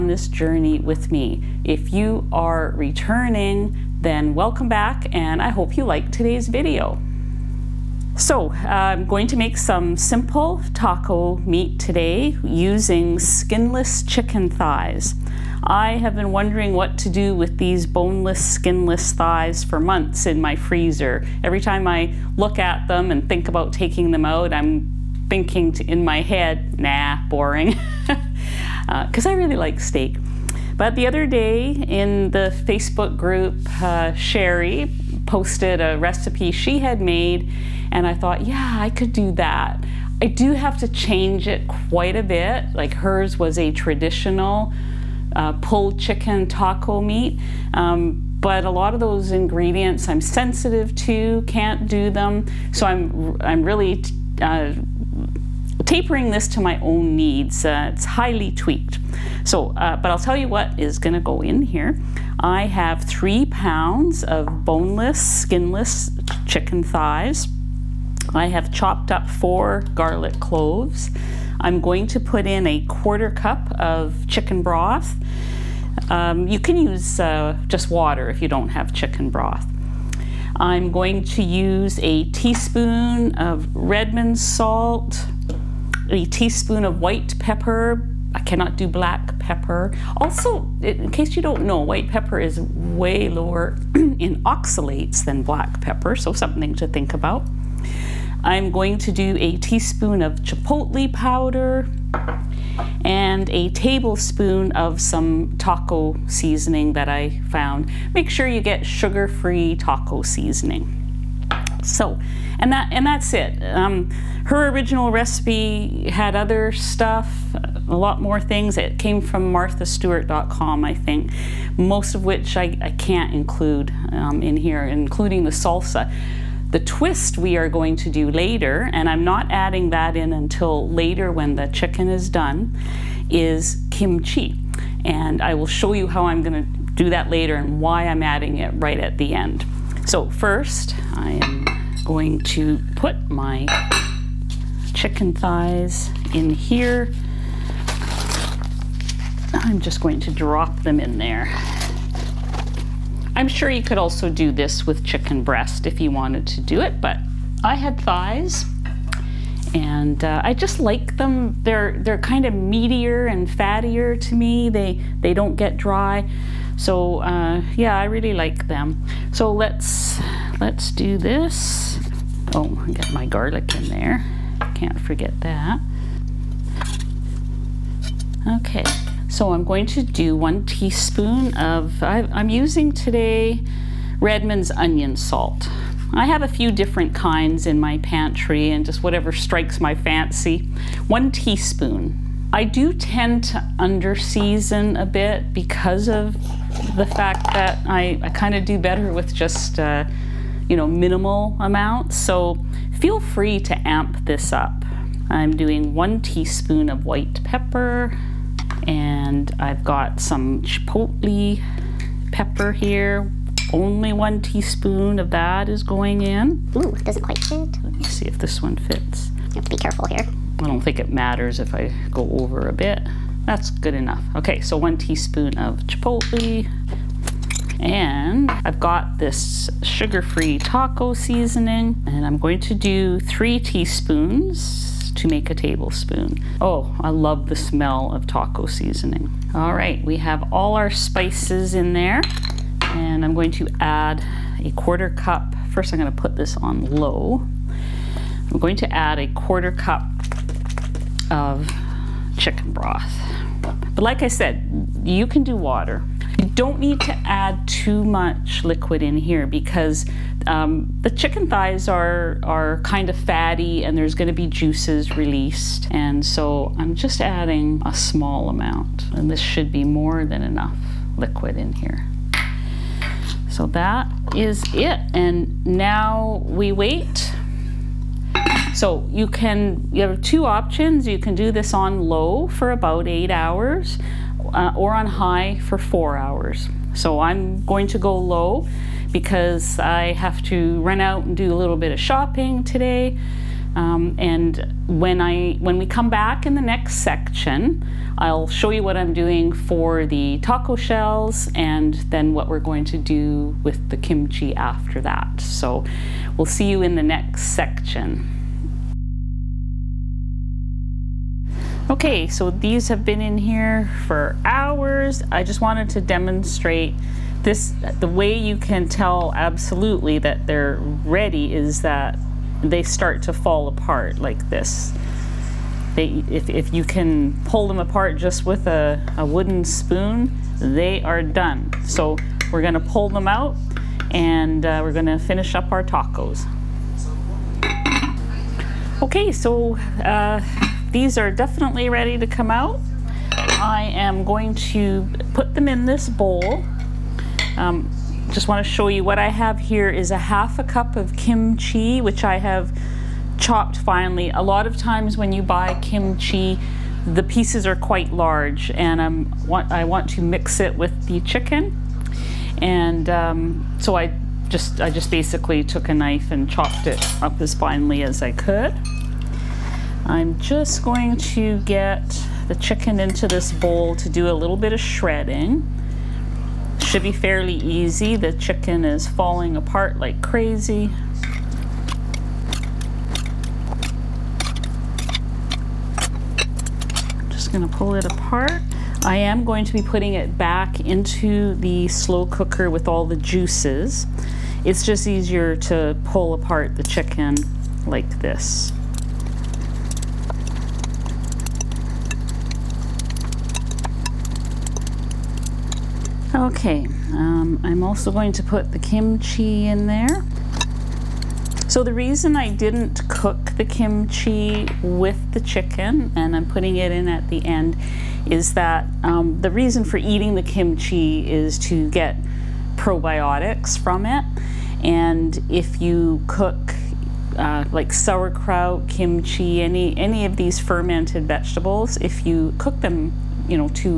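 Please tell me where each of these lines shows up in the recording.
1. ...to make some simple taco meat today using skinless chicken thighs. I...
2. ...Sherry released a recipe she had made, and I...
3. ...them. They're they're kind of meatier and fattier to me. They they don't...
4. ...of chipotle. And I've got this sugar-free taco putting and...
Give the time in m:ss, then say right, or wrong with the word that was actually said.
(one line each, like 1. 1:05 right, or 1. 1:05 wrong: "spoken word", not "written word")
1. 0:09 right
2. 0:34 wrong: "posted", not "released"
3. 2:41 right
4. 3:45 wrong: "seasoning", not "putting".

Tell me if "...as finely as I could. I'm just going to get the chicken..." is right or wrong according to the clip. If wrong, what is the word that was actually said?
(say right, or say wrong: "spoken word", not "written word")
right.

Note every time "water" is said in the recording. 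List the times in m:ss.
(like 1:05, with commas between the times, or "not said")
1:17, 4:15.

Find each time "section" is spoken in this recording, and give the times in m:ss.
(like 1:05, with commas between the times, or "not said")
4:56, 5:07.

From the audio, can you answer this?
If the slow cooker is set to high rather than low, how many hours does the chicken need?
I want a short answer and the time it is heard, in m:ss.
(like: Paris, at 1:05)
4 hours, at 4:45.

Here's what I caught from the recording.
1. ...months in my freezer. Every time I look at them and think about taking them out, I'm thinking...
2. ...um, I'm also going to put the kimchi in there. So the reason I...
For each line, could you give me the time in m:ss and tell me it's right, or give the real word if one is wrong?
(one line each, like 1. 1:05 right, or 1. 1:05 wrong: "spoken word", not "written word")
1. 0:19 right
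2. 6:47 right.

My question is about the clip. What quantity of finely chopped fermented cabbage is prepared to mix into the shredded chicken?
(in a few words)
half a cup.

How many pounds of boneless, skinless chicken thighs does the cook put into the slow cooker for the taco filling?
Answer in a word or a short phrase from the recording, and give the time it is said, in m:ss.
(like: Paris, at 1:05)
3, at 1:03.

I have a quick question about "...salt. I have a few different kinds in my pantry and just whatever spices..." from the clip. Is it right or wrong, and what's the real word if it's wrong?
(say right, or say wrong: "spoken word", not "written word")
wrong: "strikes", not "spices".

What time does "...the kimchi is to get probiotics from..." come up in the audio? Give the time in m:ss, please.
7:00.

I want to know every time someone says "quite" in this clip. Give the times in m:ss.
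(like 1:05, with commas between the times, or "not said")
0:41, 3:37, 5:57.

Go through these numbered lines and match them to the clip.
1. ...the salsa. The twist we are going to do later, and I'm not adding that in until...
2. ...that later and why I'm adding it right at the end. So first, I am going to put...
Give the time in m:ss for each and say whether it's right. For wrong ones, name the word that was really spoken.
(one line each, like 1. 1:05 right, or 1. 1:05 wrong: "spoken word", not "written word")
1. 2:05 right
2. 2:17 right.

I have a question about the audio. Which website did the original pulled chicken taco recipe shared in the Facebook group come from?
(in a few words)
marthastewart.com.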